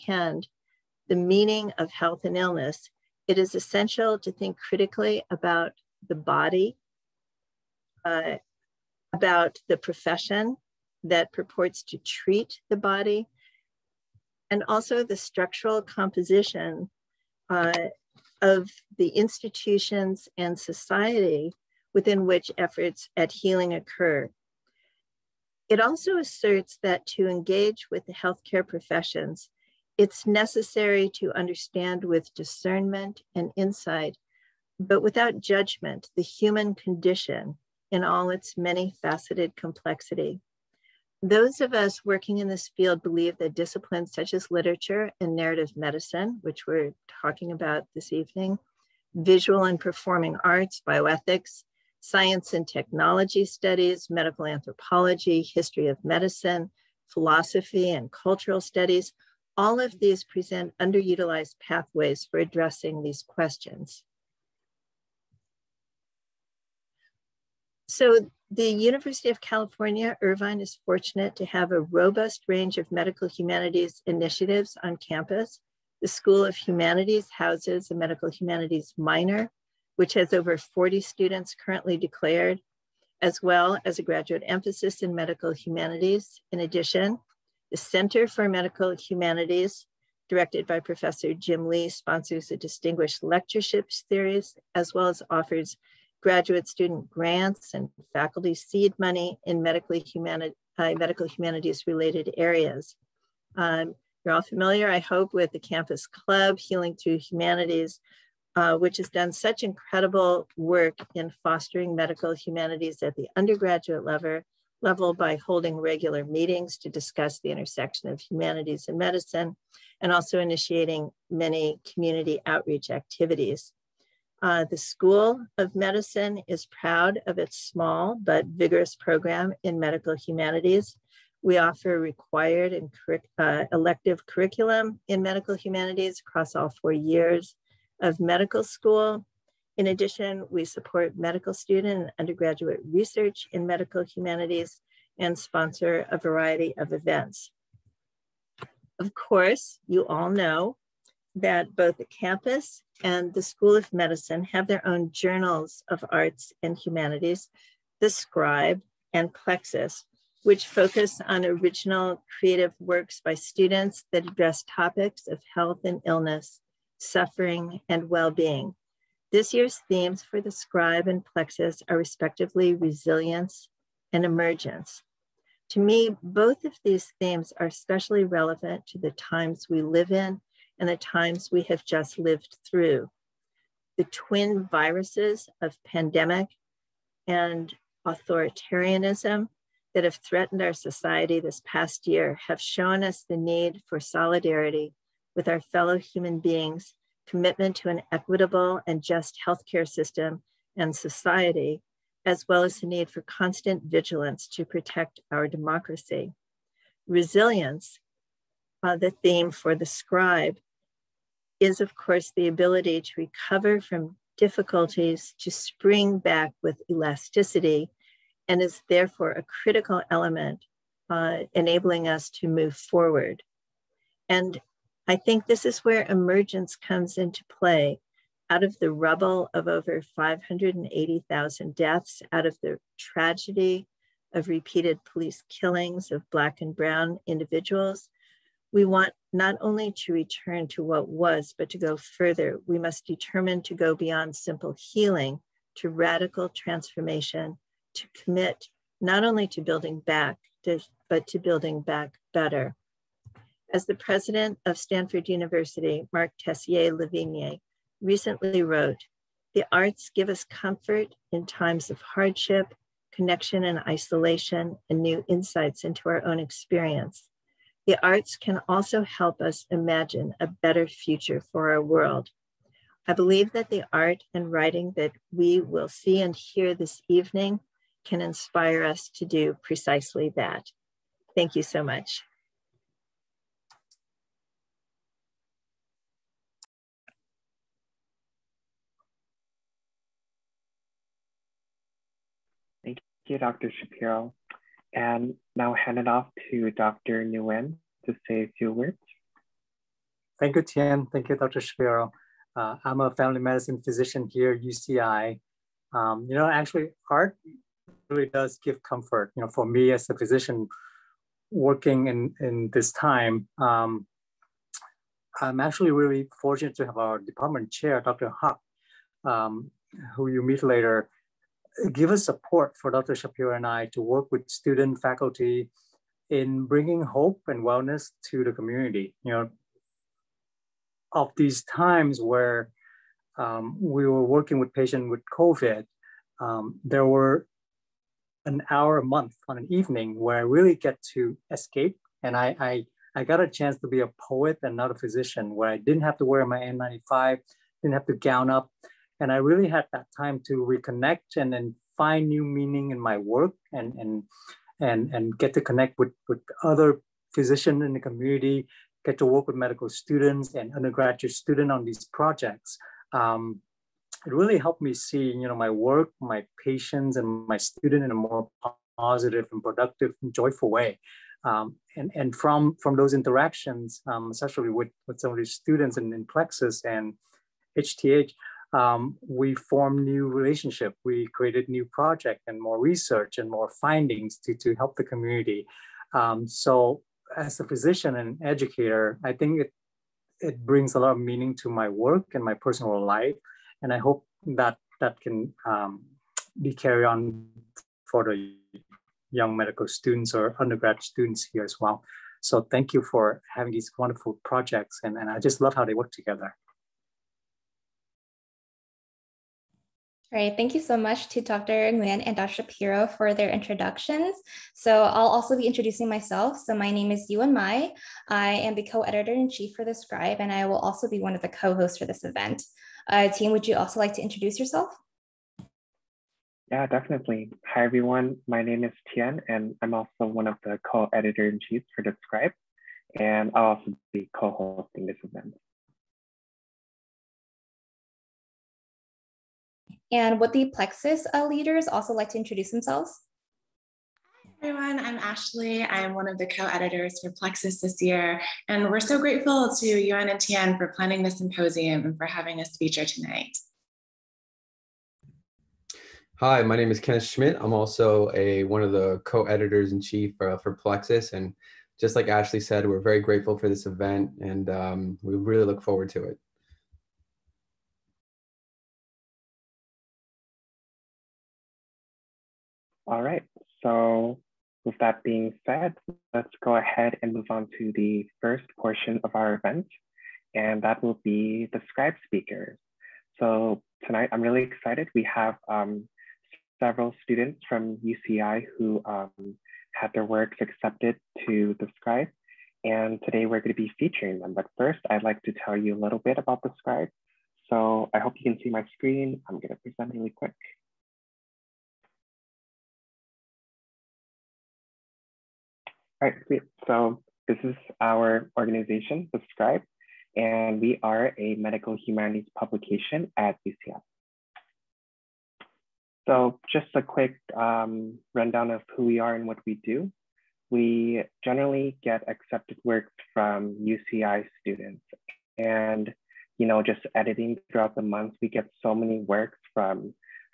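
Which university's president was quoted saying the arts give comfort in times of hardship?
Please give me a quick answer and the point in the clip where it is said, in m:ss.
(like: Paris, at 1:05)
Stanford University, at 4:14.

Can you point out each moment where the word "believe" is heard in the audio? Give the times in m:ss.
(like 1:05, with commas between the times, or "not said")
0:43, 4:33.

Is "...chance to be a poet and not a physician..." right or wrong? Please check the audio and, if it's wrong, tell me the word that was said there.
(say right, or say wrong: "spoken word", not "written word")
right.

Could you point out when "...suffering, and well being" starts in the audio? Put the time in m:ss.
2:46.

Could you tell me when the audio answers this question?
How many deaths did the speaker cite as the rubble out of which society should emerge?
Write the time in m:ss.
3:49.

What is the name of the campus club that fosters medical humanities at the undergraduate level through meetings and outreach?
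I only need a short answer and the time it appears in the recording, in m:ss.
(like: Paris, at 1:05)
Healing Through Humanities, at 1:46.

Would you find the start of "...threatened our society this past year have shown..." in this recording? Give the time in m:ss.
3:10.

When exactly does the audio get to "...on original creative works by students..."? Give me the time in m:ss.
2:41.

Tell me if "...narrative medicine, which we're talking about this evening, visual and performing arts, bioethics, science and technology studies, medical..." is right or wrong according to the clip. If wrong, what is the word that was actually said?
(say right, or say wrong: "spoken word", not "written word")
right.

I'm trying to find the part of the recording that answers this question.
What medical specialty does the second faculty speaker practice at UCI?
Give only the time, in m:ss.
5:03.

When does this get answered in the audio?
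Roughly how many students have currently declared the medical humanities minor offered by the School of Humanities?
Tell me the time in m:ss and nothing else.
1:20.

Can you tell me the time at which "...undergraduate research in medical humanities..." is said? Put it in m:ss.
2:22.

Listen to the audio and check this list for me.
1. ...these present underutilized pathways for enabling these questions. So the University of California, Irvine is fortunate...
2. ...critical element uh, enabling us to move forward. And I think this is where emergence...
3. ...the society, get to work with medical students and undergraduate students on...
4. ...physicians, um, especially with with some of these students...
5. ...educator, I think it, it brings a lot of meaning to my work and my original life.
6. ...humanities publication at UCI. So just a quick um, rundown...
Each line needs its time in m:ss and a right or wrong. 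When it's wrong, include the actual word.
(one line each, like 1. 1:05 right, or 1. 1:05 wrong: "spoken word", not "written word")
1. 0:59 wrong: "addressing", not "enabling"
2. 3:39 right
3. 5:57 wrong: "community", not "society"
4. 6:13 wrong: "interactions", not "physicians"
5. 6:28 wrong: "personal", not "original"
6. 8:31 right.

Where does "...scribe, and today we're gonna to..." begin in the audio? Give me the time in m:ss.
8:11.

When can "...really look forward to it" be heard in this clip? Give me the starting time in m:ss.
7:45.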